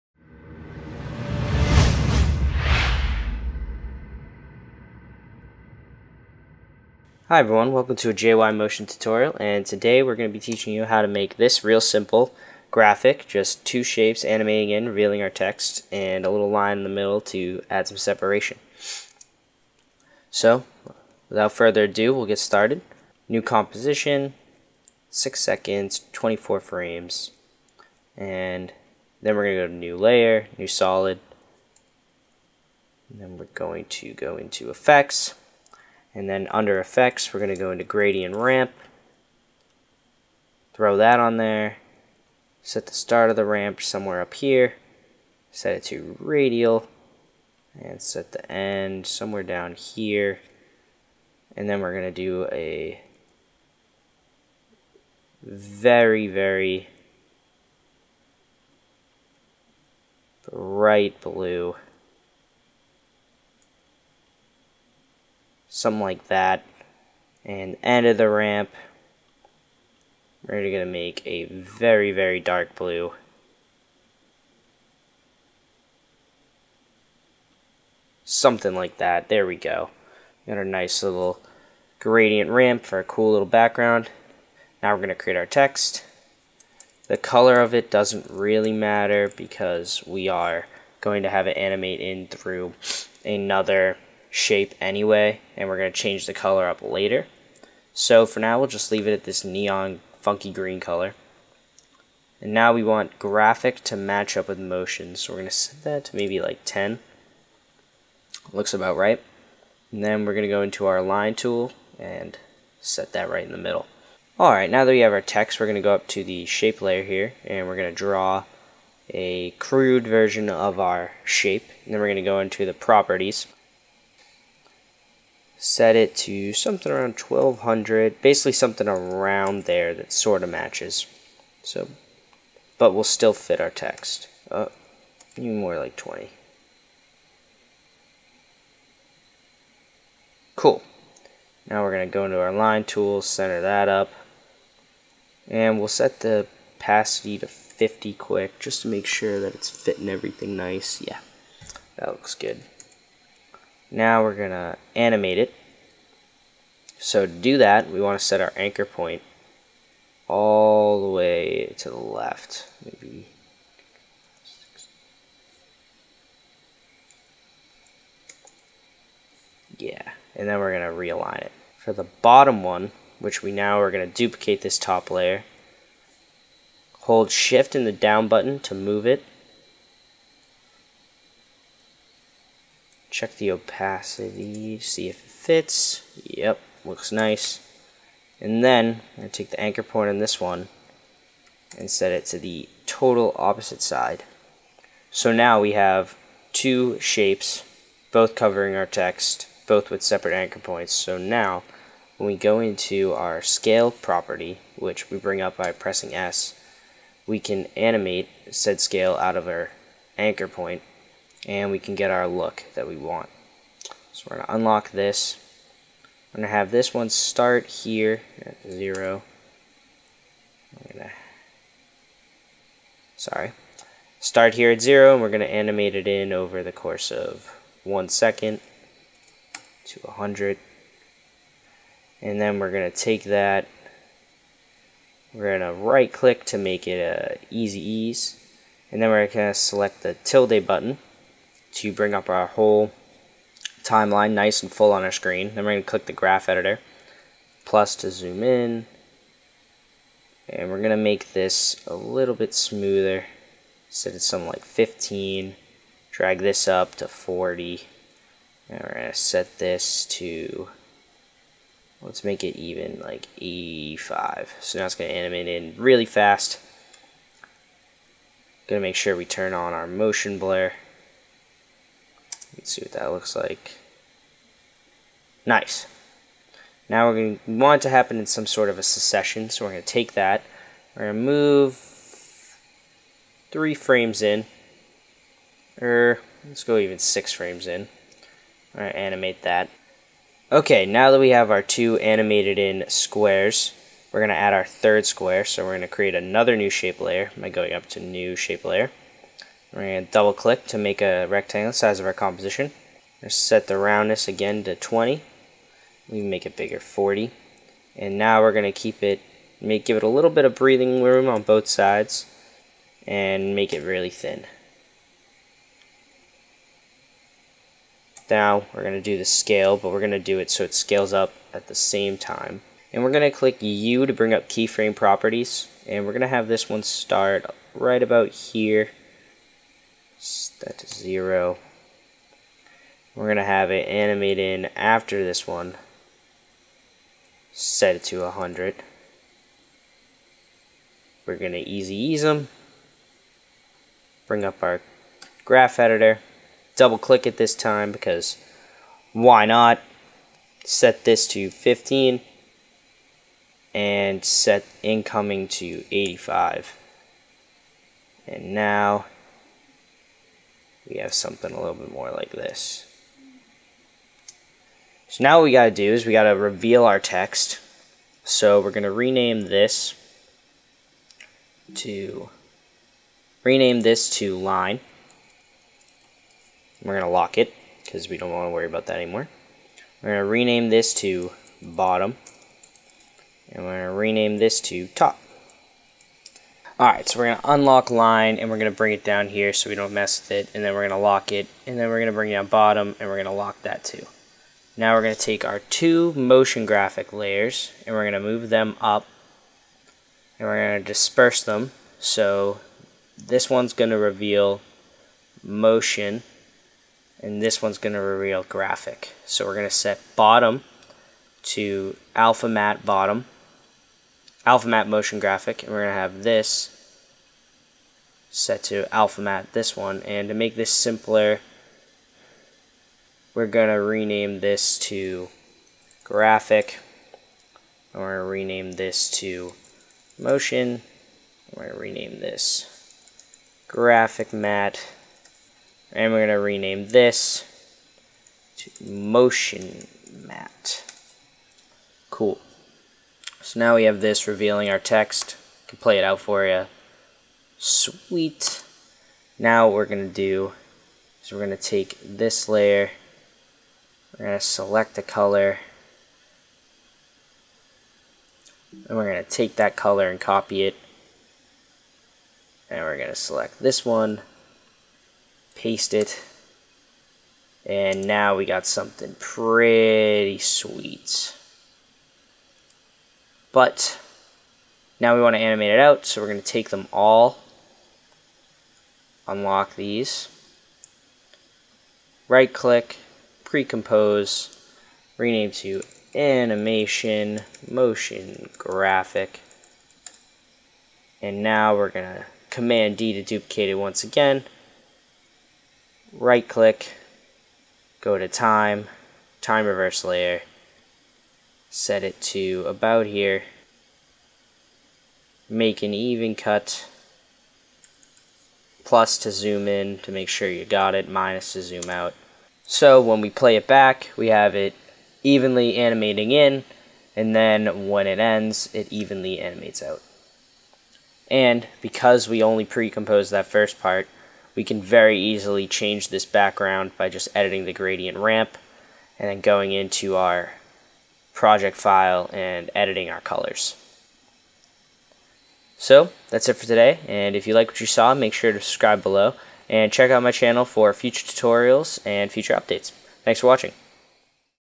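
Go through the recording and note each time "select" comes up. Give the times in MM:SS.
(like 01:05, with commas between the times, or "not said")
03:59, 07:34, 07:43.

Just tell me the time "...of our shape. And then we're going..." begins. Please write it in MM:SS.
02:00.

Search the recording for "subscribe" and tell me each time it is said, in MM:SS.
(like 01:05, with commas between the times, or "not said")
08:58.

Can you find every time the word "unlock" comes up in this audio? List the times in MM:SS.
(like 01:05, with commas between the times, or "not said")
03:34, 06:27, 07:59.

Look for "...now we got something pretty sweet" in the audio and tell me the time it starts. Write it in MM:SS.
07:48.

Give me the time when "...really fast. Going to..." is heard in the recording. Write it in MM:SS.
04:25.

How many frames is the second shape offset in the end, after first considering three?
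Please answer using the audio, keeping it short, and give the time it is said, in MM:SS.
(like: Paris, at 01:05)
6, at 04:46.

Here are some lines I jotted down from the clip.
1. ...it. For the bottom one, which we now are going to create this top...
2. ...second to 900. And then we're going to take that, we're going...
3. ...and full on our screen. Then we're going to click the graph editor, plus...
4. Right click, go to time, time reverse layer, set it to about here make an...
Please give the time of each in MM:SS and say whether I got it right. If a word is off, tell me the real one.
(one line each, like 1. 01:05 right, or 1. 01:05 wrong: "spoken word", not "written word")
1. 02:51 wrong: "duplicate", not "create"
2. 03:48 wrong: "100", not "900"
3. 04:04 right
4. 08:16 right.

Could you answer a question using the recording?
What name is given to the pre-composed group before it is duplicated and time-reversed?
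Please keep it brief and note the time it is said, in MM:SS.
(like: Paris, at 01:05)
animation motion graphic, at 08:06.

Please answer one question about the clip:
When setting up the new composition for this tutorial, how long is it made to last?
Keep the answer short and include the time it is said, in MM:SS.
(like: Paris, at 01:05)
6 seconds, at 00:25.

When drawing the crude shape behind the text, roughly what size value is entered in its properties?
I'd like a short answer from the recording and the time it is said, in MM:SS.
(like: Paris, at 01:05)
1200, at 02:07.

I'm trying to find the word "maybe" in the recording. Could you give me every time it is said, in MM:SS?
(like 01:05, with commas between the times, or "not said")
01:46, 02:42.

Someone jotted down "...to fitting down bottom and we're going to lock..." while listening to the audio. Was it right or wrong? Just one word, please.
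wrong.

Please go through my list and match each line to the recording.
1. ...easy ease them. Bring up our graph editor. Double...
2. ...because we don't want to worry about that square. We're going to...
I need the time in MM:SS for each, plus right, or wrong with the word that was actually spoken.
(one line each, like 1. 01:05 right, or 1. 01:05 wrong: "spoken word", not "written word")
1. 05:41 right
2. 06:17 wrong: "anymore", not "square".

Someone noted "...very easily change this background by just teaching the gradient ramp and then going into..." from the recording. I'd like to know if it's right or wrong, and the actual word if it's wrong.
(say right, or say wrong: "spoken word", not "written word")
wrong: "editing", not "teaching".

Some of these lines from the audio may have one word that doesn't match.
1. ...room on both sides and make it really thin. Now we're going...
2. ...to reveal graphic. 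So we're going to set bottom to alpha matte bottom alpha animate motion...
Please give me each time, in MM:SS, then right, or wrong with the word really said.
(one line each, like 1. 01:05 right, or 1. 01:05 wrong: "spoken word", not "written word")
1. 05:11 right
2. 06:47 wrong: "matte", not "animate".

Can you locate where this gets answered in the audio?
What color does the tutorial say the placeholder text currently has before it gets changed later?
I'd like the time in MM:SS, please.
01:39.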